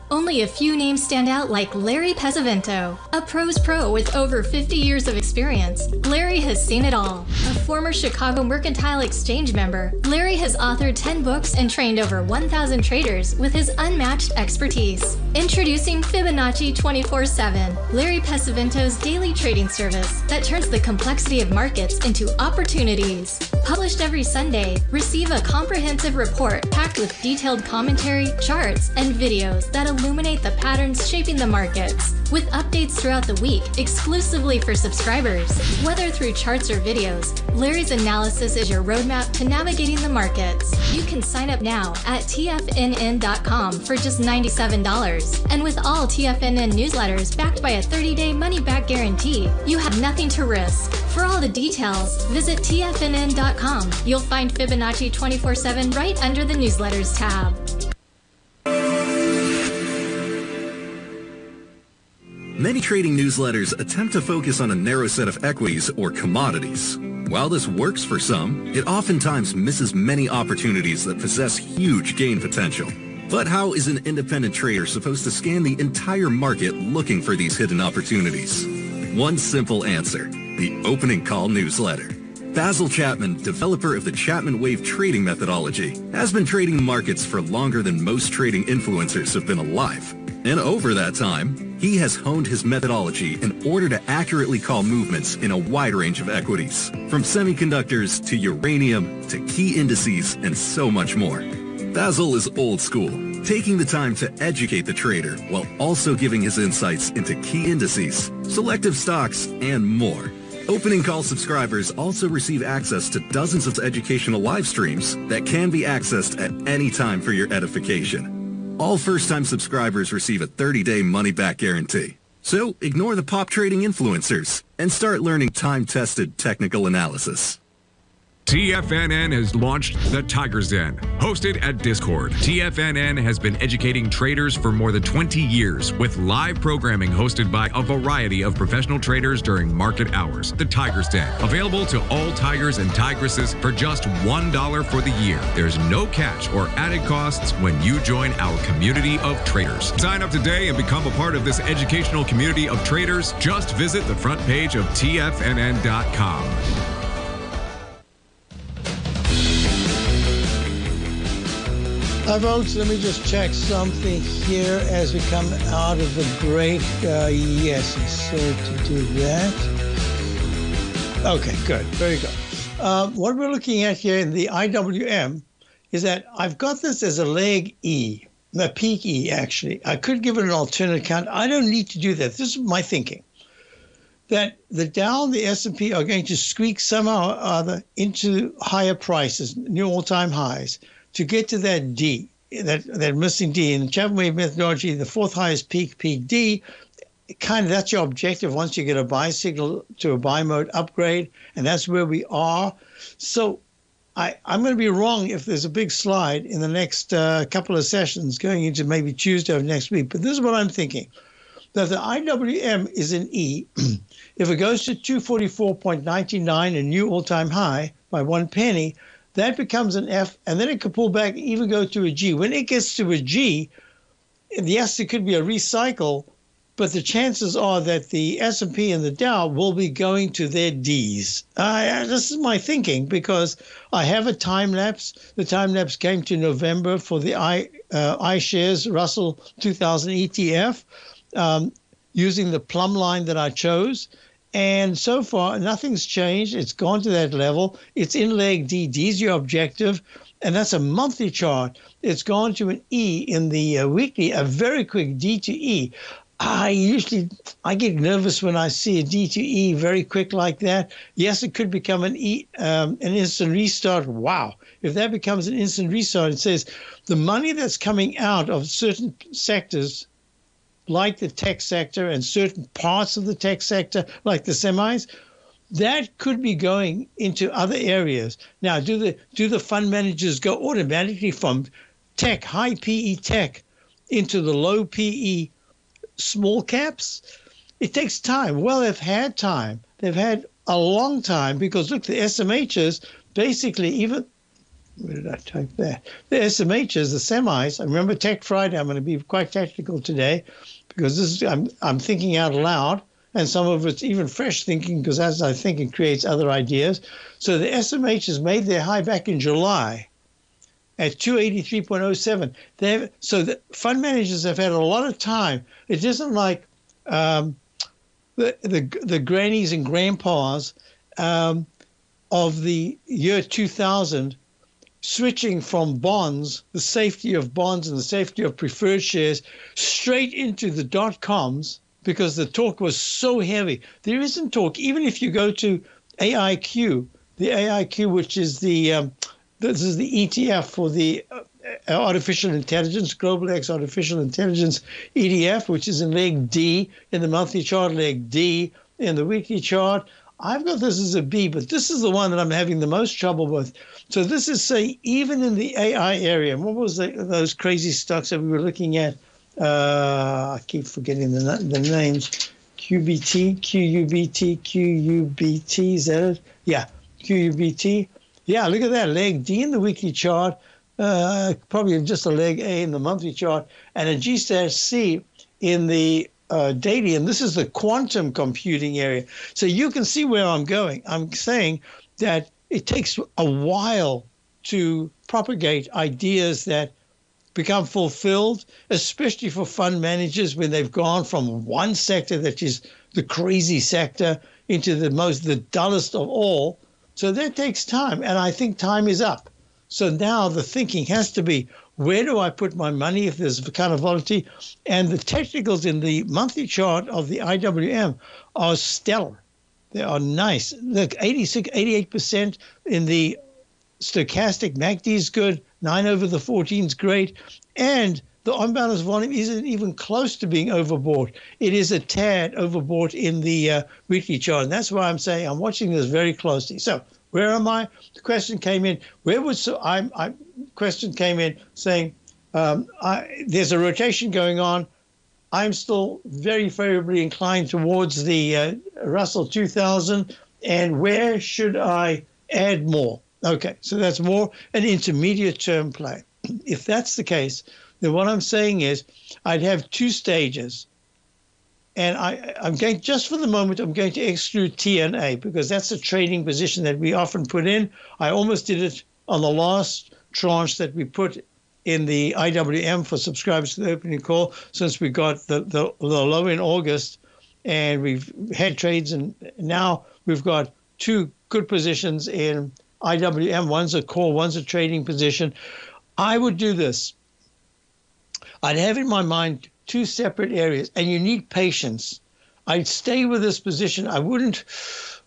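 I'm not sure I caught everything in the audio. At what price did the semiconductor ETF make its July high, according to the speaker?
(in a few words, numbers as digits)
283.07.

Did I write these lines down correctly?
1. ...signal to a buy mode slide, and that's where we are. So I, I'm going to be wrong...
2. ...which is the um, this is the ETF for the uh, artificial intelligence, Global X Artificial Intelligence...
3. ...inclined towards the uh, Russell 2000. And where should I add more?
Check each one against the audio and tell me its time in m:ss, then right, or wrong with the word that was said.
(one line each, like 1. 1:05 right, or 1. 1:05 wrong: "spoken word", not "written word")
1. 3:19 wrong: "upgrade", not "slide"
2. 5:38 right
3. 7:17 right.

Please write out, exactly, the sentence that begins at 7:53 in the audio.
One's a call, one's a trading position.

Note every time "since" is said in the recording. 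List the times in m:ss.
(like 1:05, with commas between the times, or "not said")
7:44.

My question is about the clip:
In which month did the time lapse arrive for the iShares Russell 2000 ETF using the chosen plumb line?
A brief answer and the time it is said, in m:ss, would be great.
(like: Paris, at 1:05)
November, at 3:56.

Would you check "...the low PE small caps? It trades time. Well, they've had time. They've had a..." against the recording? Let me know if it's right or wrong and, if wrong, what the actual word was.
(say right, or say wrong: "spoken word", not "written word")
wrong: "takes", not "trades".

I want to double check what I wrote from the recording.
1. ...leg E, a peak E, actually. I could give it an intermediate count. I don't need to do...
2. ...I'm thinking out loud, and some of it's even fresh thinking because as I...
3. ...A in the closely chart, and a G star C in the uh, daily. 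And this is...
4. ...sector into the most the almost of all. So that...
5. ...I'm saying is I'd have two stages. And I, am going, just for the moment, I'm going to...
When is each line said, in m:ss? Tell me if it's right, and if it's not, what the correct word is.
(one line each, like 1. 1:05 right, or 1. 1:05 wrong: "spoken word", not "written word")
1. 2:57 wrong: "alternate", not "intermediate"
2. 5:01 right
3. 6:12 wrong: "monthly", not "closely"
4. 6:33 wrong: "dullest", not "almost"
5. 7:28 right.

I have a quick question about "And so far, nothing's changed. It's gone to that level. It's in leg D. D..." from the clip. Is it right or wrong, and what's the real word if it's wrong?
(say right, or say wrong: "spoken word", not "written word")
right.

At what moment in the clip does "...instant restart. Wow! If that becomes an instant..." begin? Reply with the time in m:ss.
4:23.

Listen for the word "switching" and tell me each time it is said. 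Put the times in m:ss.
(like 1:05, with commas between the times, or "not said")
5:25.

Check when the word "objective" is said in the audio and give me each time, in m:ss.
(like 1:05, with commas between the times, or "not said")
3:18, 4:09.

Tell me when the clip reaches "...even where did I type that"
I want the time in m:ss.
4:53.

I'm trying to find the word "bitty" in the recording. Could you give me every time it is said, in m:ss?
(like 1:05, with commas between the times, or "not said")
not said.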